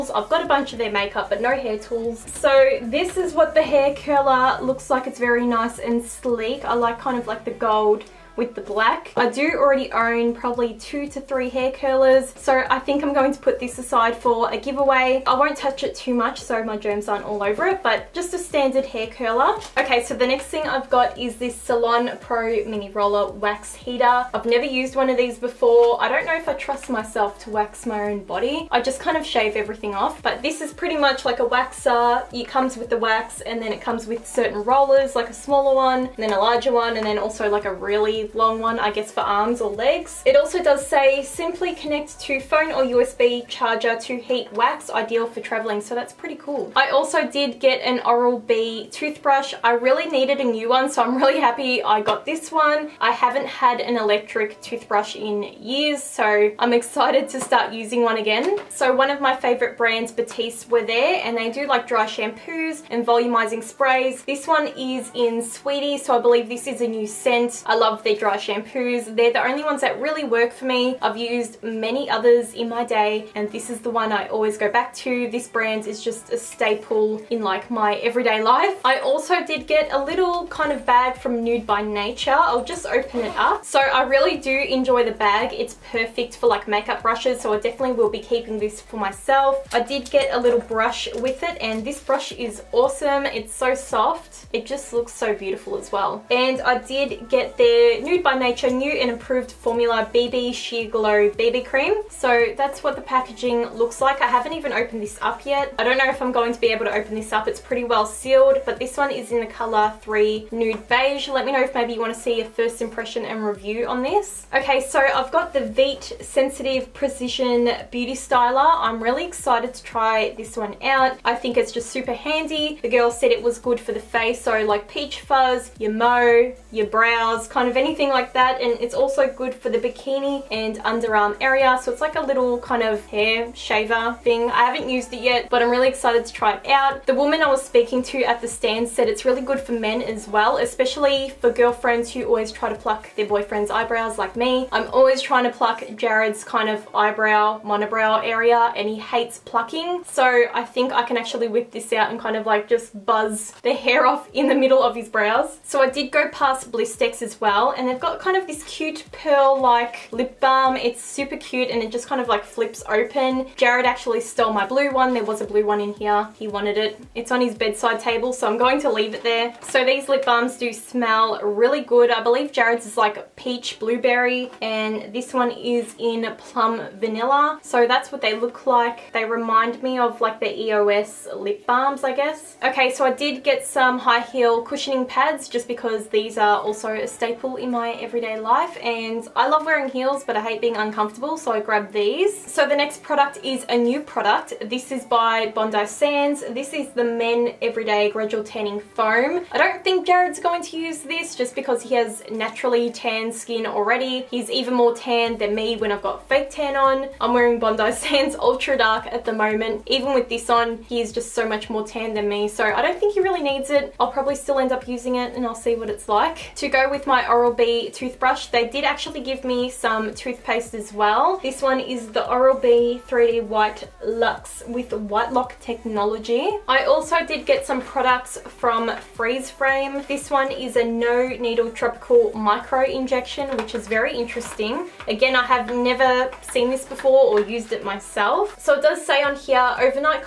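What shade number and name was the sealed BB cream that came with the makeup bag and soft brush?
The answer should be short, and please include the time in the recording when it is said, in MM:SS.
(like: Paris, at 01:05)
3 Nude Beige, at 01:50.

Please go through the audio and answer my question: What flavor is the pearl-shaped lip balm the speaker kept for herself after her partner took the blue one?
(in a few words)
plum vanilla.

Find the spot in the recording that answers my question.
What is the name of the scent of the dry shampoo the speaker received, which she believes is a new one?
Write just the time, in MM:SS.
01:05.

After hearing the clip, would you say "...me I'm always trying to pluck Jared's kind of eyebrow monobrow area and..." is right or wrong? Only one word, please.
right.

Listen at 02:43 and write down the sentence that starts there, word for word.
Jared actually stole my blue one.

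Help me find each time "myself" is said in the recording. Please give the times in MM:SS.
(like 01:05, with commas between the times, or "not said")
00:26, 01:28, 03:57.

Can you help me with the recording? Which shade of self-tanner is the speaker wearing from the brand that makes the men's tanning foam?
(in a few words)
Ultra Dark.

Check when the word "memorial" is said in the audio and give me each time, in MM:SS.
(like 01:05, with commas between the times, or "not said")
not said.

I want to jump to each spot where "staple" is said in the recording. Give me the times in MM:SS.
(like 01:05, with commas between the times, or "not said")
01:16, 03:07.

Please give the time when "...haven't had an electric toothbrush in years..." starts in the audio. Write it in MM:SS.
00:53.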